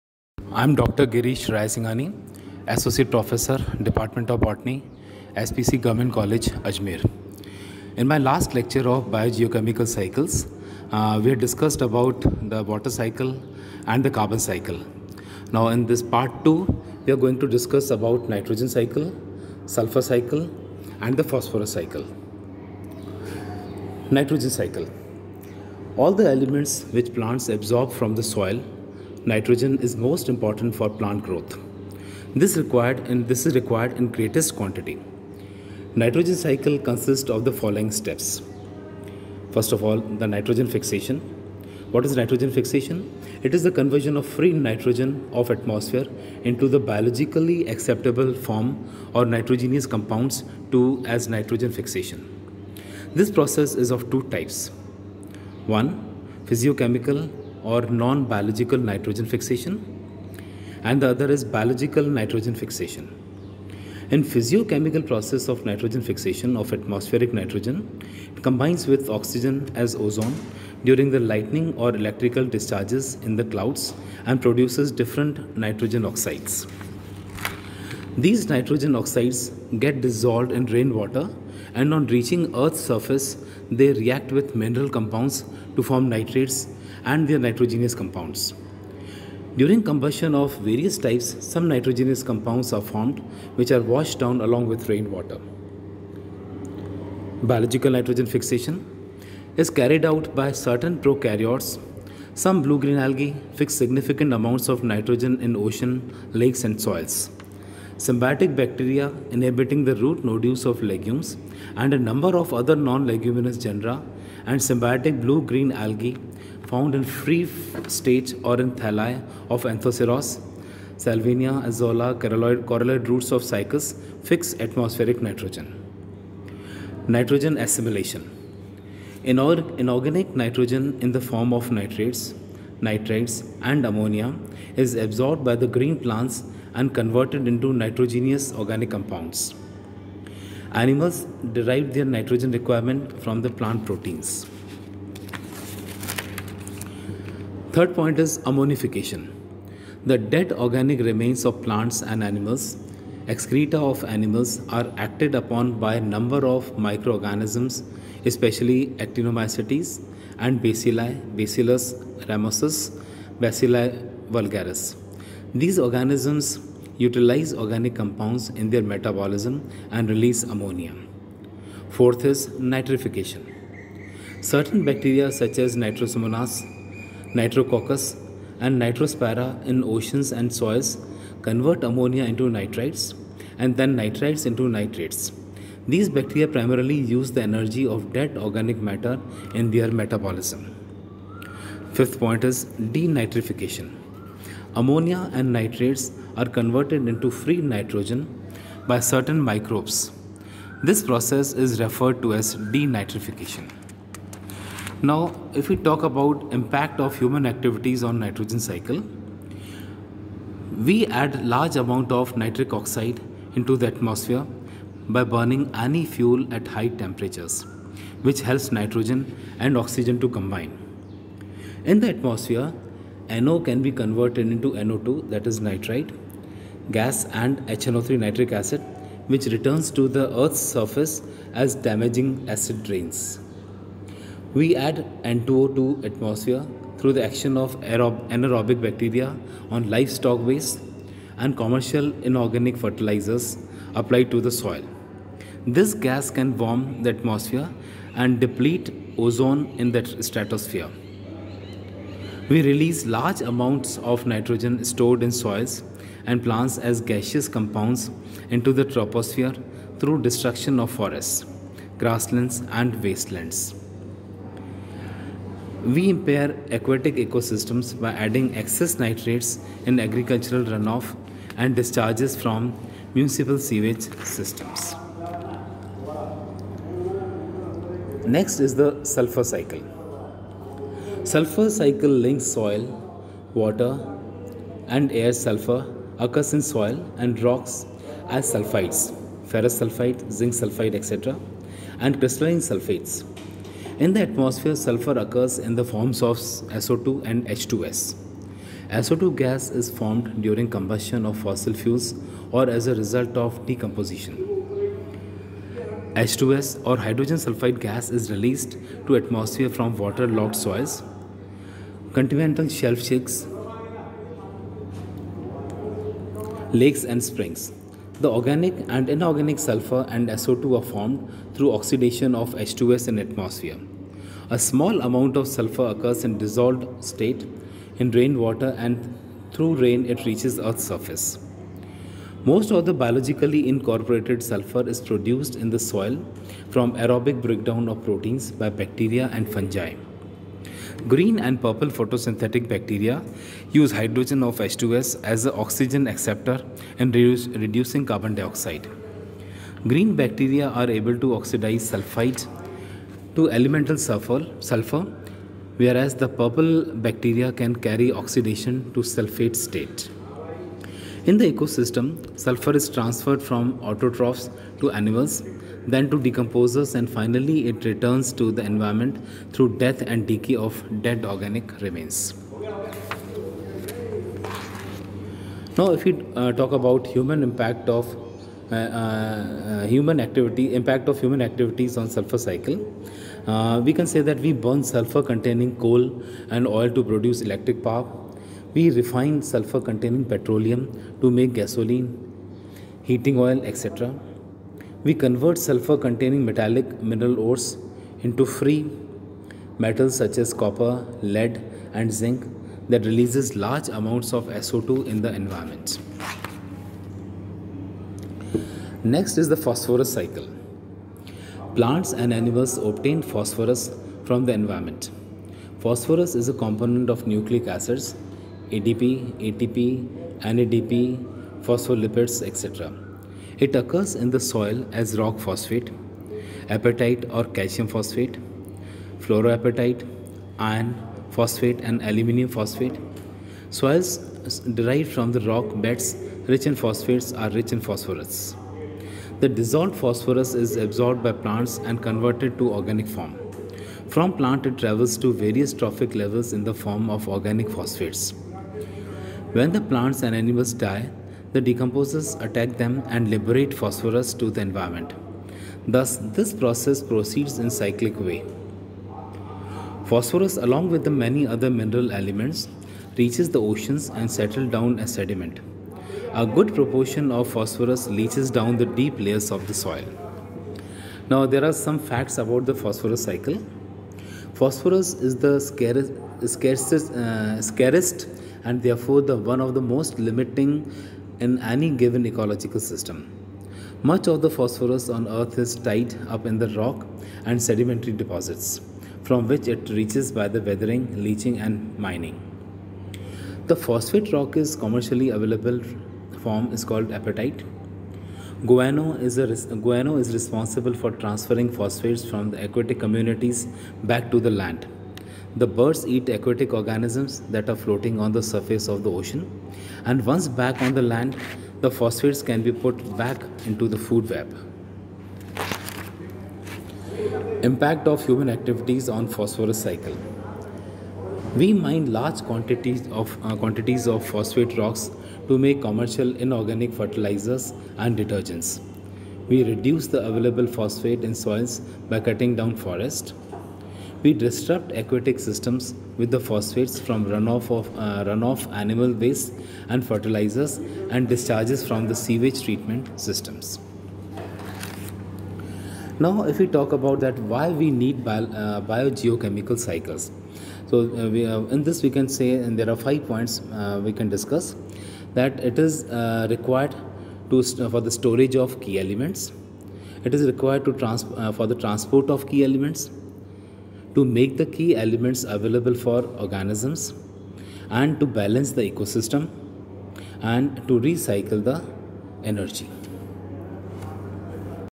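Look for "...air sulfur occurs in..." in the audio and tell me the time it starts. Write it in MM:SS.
04:45.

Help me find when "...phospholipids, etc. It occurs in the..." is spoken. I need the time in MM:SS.
07:01.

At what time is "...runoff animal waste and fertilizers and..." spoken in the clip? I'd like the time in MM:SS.
08:58.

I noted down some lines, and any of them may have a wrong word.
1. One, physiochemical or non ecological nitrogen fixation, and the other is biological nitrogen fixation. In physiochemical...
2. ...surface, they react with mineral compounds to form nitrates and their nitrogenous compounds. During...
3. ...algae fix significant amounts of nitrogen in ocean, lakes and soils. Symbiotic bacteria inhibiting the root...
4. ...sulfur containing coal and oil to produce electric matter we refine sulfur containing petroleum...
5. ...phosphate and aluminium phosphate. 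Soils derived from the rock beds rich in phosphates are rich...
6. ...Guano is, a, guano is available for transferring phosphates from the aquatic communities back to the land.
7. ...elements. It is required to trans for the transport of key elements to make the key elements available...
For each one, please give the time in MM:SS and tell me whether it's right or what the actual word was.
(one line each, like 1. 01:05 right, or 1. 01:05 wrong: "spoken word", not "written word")
1. 00:55 wrong: "biological", not "ecological"
2. 01:22 right
3. 01:42 right
4. 06:24 wrong: "power", not "matter"
5. 07:11 right
6. 08:18 wrong: "responsible", not "available"
7. 09:18 right.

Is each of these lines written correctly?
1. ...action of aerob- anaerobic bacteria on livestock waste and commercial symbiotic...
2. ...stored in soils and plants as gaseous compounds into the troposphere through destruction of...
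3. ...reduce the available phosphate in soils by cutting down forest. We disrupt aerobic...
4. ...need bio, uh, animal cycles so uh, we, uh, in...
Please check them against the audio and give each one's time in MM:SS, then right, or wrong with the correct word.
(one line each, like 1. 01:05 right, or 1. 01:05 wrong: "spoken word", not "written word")
1. 03:57 wrong: "inorganic", not "symbiotic"
2. 04:14 right
3. 08:49 wrong: "aquatic", not "aerobic"
4. 09:07 wrong: "biogeochemical", not "animal".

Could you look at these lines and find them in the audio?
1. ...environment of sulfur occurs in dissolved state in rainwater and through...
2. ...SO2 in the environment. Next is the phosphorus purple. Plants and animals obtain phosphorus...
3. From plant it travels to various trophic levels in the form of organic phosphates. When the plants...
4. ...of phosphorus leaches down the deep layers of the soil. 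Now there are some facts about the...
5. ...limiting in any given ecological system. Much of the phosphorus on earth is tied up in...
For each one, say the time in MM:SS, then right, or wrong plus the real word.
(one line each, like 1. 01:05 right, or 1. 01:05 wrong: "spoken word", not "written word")
1. 05:25 wrong: "amount", not "environment"
2. 06:44 wrong: "cycle", not "purple"
3. 07:24 right
4. 07:47 right
5. 08:00 right.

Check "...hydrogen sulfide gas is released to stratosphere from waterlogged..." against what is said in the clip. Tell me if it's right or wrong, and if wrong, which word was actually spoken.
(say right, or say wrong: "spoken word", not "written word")
wrong: "atmosphere", not "stratosphere".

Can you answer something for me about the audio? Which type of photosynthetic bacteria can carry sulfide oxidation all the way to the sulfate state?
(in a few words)
purple bacteria.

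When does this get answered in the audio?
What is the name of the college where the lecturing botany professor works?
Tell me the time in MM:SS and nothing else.
00:05.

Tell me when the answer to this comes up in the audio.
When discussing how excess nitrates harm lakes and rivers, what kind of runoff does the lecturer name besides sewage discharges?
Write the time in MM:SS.
04:29.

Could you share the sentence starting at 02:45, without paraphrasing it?
These organisms utilize organic compounds in their metabolism and release ammonia.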